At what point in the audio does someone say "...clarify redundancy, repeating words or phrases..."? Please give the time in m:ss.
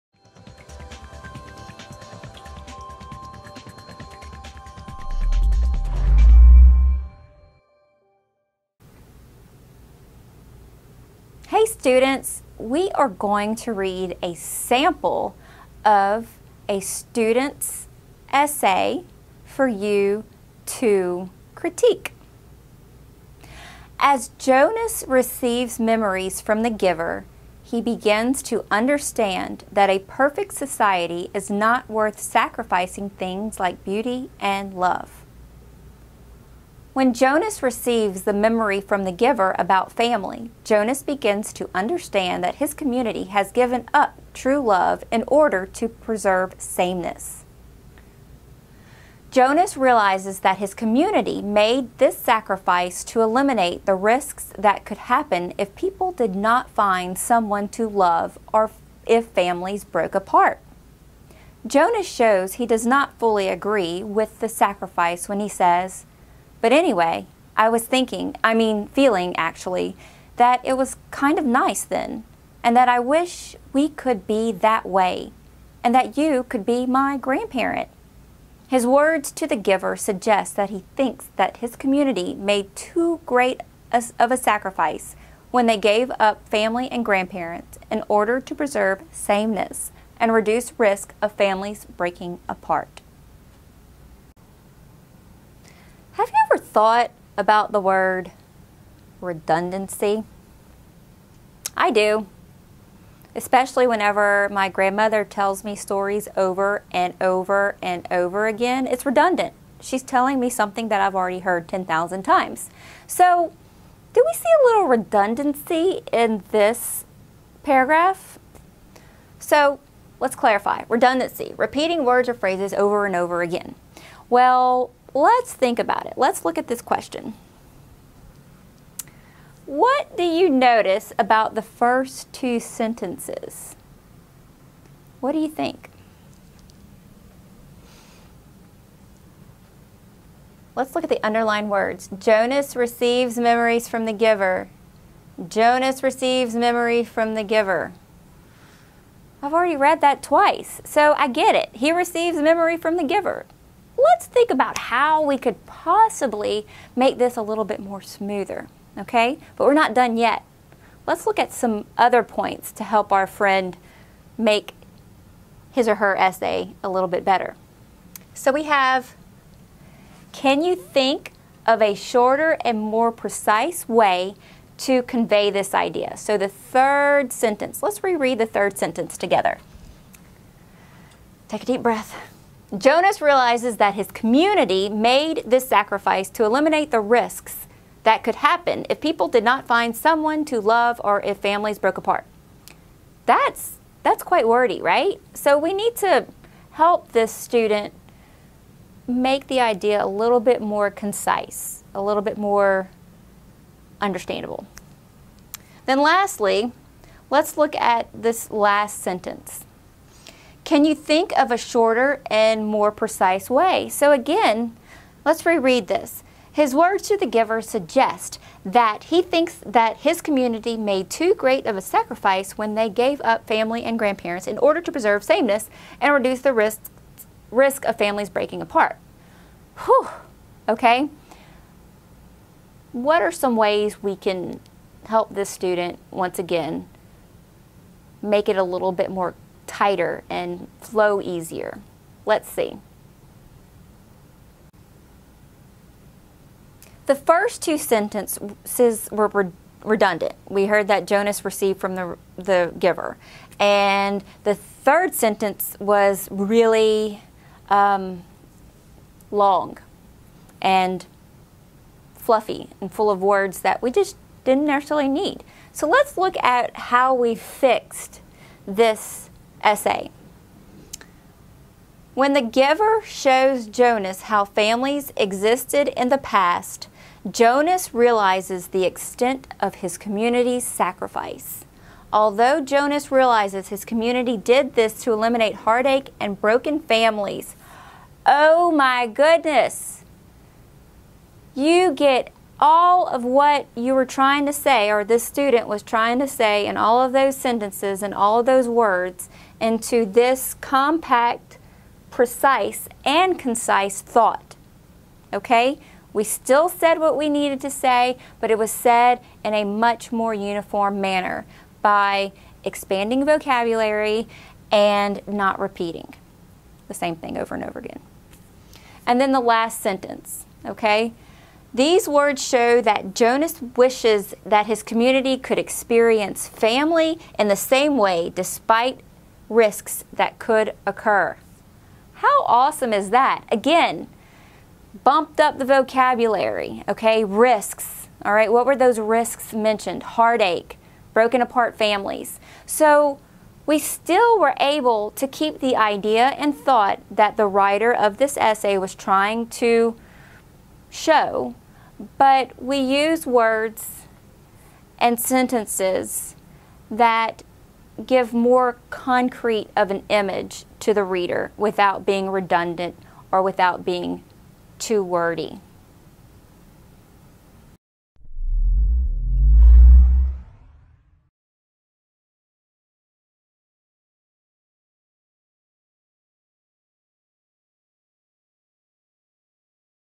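2:00.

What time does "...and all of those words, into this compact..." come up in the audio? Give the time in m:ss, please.
4:58.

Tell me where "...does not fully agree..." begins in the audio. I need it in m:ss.
1:02.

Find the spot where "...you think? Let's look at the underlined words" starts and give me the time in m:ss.
2:15.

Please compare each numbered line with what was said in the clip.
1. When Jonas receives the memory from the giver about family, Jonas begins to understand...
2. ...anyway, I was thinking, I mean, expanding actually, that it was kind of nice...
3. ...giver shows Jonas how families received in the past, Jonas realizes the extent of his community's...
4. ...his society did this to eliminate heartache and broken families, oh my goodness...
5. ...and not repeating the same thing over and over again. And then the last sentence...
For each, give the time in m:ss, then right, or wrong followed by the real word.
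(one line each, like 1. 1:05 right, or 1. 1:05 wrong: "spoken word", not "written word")
1. 0:36 right
2. 1:06 wrong: "feeling", not "expanding"
3. 4:32 wrong: "existed", not "received"
4. 4:43 wrong: "community", not "society"
5. 5:14 right.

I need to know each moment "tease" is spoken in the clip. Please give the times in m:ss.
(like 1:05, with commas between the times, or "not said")
not said.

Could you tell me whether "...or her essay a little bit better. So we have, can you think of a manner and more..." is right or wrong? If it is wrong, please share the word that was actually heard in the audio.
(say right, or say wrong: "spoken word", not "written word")
wrong: "shorter", not "manner".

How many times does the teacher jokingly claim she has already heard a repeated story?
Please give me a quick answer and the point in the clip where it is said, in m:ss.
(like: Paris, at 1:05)
10,000, at 1:51.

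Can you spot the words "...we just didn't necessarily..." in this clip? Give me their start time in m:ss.
4:23.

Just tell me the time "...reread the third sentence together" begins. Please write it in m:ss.
2:58.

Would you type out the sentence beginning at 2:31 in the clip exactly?
He receives memory from the giver let's think about how we could possibly make this a little bit more smoother, okay?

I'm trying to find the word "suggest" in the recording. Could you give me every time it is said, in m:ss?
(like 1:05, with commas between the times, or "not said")
1:19, 3:37.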